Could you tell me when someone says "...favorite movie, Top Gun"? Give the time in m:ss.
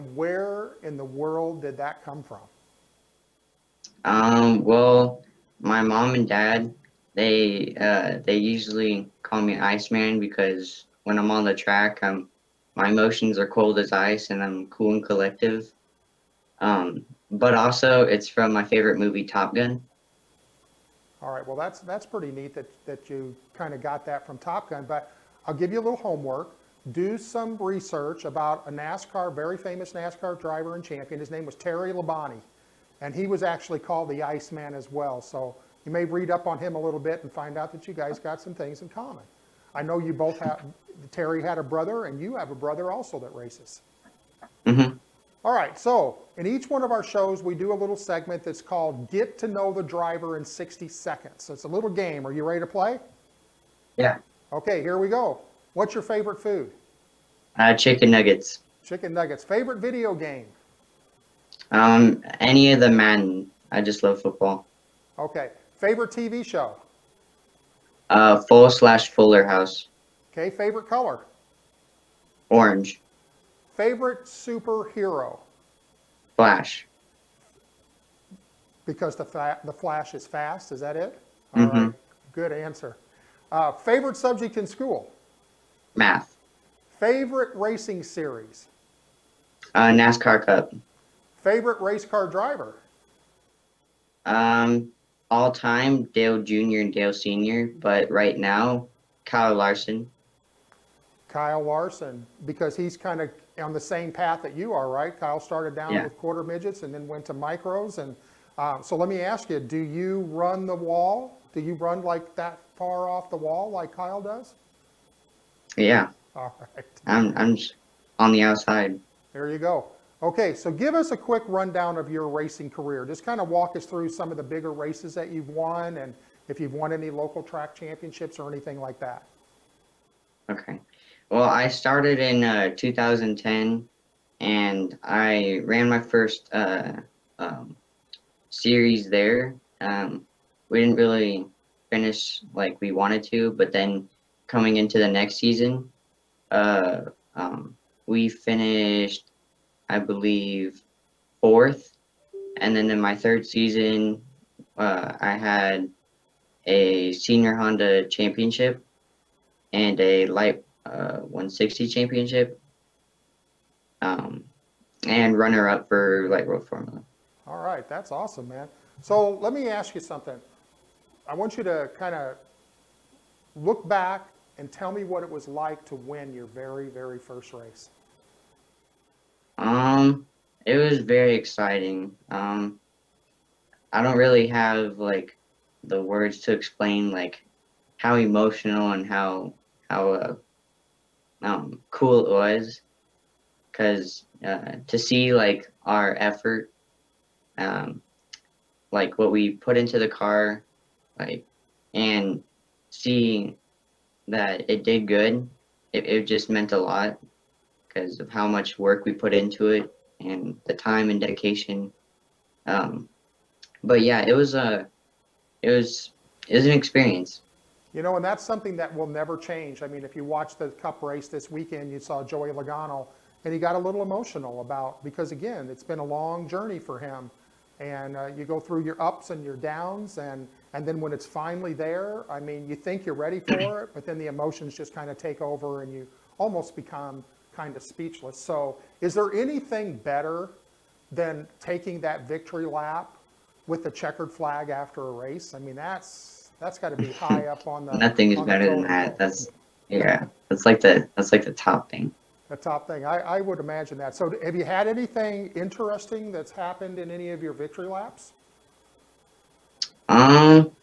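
0:18.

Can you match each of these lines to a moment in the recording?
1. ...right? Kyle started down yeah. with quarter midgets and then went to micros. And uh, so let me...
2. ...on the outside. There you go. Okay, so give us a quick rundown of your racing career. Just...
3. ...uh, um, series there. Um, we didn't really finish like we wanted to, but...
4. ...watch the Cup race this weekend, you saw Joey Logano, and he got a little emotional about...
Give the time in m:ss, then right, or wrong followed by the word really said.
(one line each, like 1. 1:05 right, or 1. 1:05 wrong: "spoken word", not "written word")
1. 1:44 right
2. 1:58 right
3. 2:16 right
4. 3:40 right.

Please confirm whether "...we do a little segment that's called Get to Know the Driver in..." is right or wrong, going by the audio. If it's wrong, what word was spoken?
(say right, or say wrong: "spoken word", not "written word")
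right.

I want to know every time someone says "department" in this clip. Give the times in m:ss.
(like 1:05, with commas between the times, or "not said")
not said.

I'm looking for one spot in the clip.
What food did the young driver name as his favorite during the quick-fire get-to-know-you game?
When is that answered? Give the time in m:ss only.
0:57.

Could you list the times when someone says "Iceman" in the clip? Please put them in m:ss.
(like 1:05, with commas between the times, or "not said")
0:09, 0:34.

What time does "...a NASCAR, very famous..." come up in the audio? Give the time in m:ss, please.
0:28.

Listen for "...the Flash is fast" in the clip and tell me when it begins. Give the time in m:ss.
1:19.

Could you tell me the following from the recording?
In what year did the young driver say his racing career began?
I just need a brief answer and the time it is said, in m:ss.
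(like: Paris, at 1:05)
2010, at 2:12.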